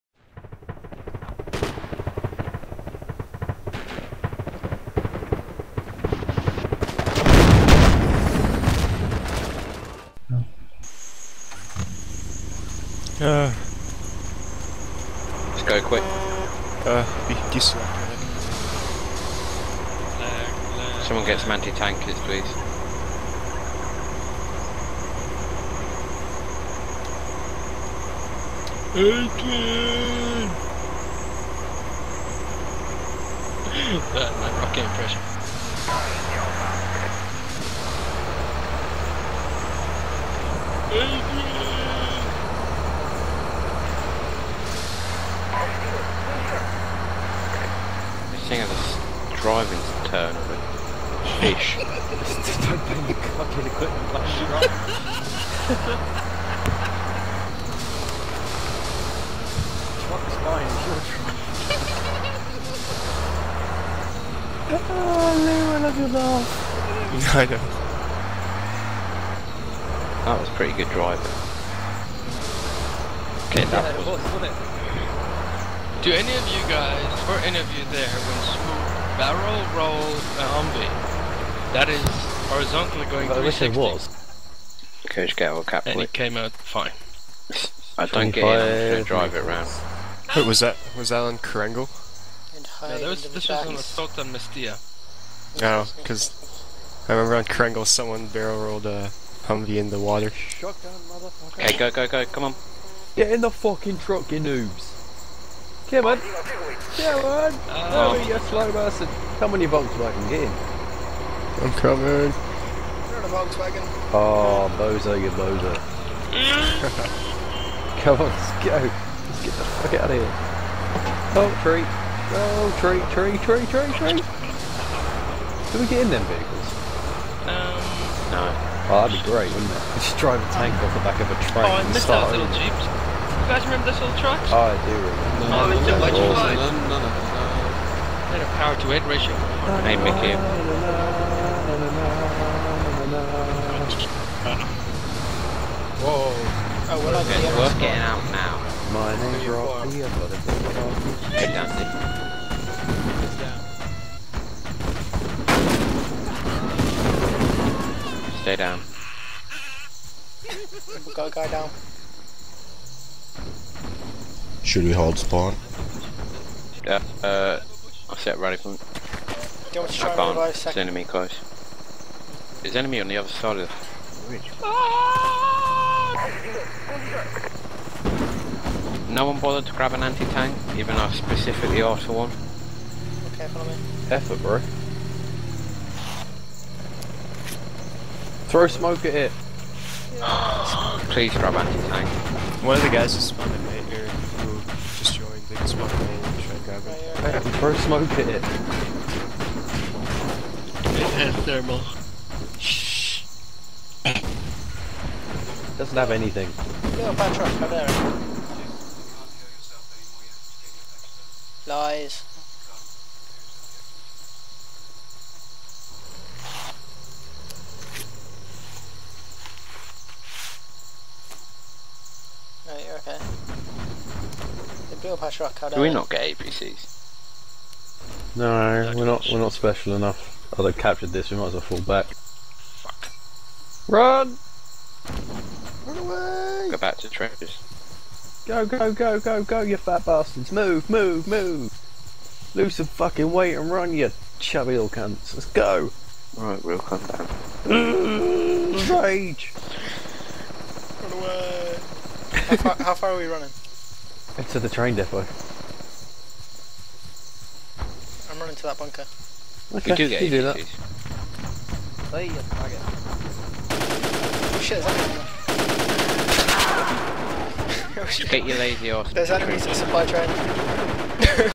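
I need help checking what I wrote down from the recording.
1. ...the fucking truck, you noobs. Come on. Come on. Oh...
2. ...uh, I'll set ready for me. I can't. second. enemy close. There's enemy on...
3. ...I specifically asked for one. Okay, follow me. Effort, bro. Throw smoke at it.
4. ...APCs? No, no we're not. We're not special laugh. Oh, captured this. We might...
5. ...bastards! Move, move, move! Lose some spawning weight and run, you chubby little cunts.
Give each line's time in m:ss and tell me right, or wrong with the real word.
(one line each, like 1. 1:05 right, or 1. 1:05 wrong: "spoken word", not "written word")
1. 1:43 right
2. 2:47 right
3. 3:01 right
4. 3:46 wrong: "enough", not "laugh"
5. 4:00 wrong: "fucking", not "spawning".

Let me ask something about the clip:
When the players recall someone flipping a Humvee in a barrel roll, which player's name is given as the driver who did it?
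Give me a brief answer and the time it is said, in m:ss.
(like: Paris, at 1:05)
Smoot, at 1:18.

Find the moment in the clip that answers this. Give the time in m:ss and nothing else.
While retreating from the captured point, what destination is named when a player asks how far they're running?
4:14.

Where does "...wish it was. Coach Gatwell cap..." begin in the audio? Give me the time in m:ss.
1:23.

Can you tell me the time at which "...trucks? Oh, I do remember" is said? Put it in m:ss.
2:14.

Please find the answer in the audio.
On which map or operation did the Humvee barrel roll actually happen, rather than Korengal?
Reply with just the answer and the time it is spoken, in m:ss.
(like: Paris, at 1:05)
Assault on Mestia, at 1:33.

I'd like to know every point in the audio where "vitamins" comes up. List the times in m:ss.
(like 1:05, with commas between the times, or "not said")
not said.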